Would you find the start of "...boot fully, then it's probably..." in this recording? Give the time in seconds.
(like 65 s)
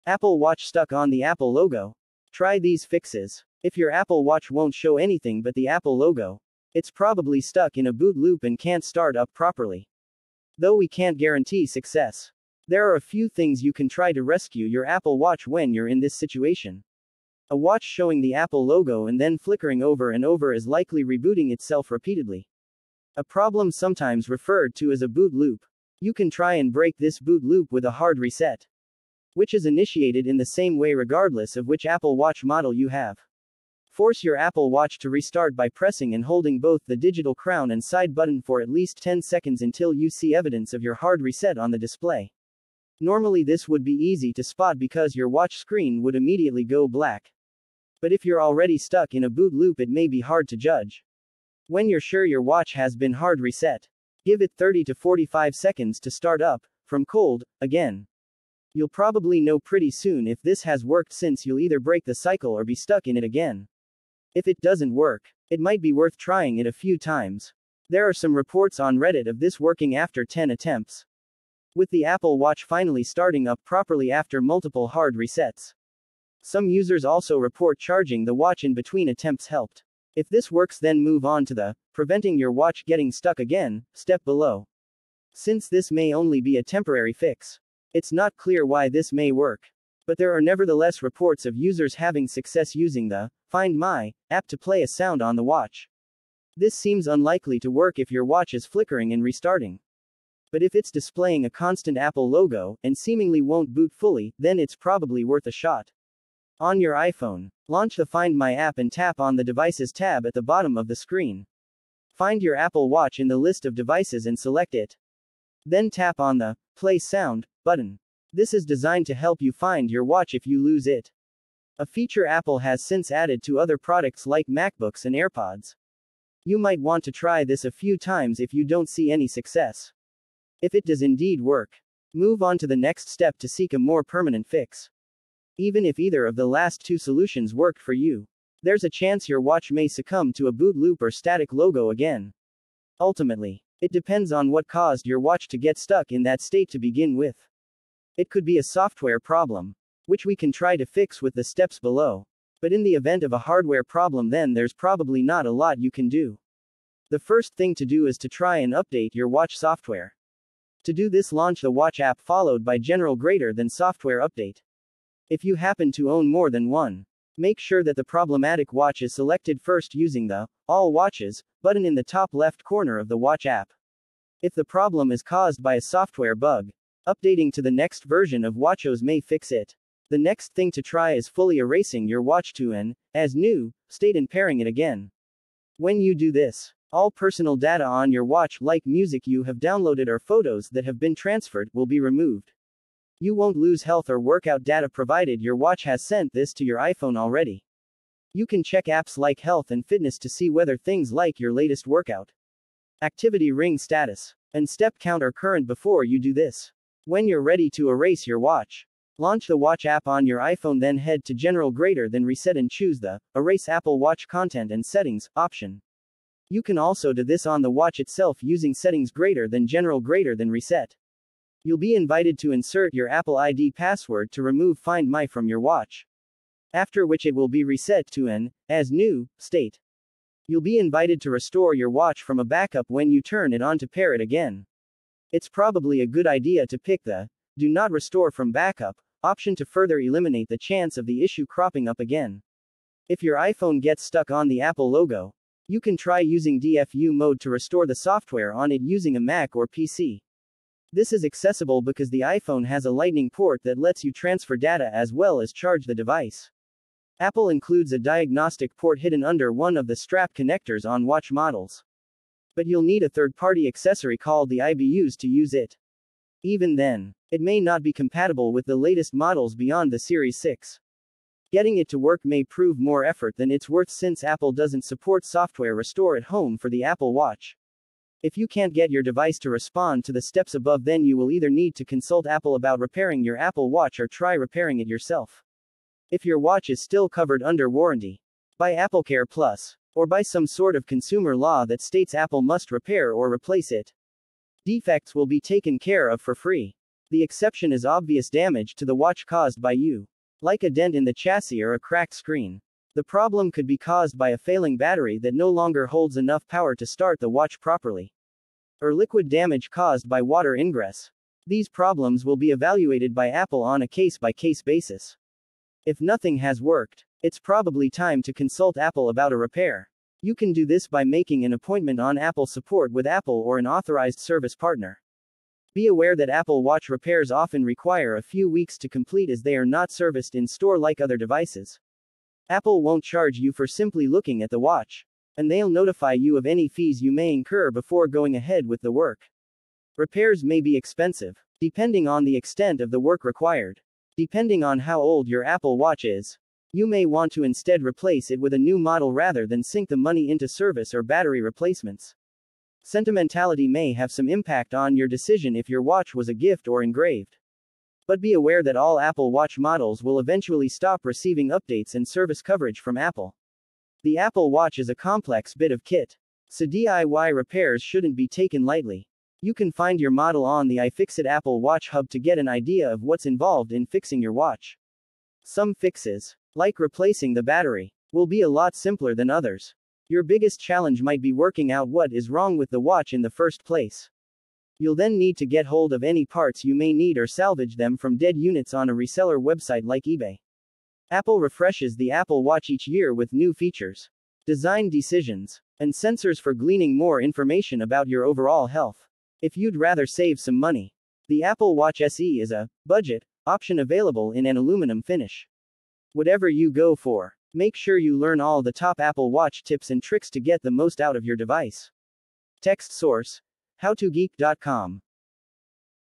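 103 s.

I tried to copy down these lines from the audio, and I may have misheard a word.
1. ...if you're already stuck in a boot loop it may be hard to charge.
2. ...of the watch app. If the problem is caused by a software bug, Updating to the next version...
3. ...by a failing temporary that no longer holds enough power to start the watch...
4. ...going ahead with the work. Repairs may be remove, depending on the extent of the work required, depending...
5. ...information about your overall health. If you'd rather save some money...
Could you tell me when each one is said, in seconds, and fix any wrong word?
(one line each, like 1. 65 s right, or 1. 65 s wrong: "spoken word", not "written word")
1. 48 s wrong: "judge", not "charge"
2. 172 s right
3. 304 s wrong: "battery", not "temporary"
4. 338 s wrong: "expensive", not "remove"
5. 397 s right.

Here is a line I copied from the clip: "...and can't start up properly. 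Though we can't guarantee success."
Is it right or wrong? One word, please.
right.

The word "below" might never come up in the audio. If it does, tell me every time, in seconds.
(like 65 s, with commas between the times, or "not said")
84 s, 151 s.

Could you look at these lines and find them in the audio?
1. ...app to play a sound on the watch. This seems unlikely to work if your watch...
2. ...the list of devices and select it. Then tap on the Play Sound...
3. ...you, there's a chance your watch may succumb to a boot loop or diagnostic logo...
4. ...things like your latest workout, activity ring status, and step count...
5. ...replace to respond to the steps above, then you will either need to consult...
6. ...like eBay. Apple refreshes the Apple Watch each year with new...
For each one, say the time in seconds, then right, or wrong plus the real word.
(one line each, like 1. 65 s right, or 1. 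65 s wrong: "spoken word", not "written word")
1. 94 s right
2. 113 s right
3. 137 s wrong: "static", not "diagnostic"
4. 200 s right
5. 279 s wrong: "device", not "replace"
6. 389 s right.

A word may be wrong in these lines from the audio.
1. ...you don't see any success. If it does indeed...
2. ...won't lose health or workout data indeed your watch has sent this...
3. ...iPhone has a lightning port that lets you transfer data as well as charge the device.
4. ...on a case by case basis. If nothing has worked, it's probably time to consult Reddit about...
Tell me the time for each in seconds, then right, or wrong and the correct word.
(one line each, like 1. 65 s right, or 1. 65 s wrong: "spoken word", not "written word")
1. 128 s right
2. 193 s wrong: "provided", not "indeed"
3. 252 s right
4. 313 s wrong: "Apple", not "Reddit".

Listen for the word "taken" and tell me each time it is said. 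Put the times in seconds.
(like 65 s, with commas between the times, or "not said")
295 s, 368 s.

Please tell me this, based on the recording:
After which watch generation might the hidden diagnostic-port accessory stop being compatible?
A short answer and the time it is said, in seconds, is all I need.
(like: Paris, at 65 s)
Series 6, at 269 s.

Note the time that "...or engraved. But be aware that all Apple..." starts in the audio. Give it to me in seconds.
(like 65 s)
356 s.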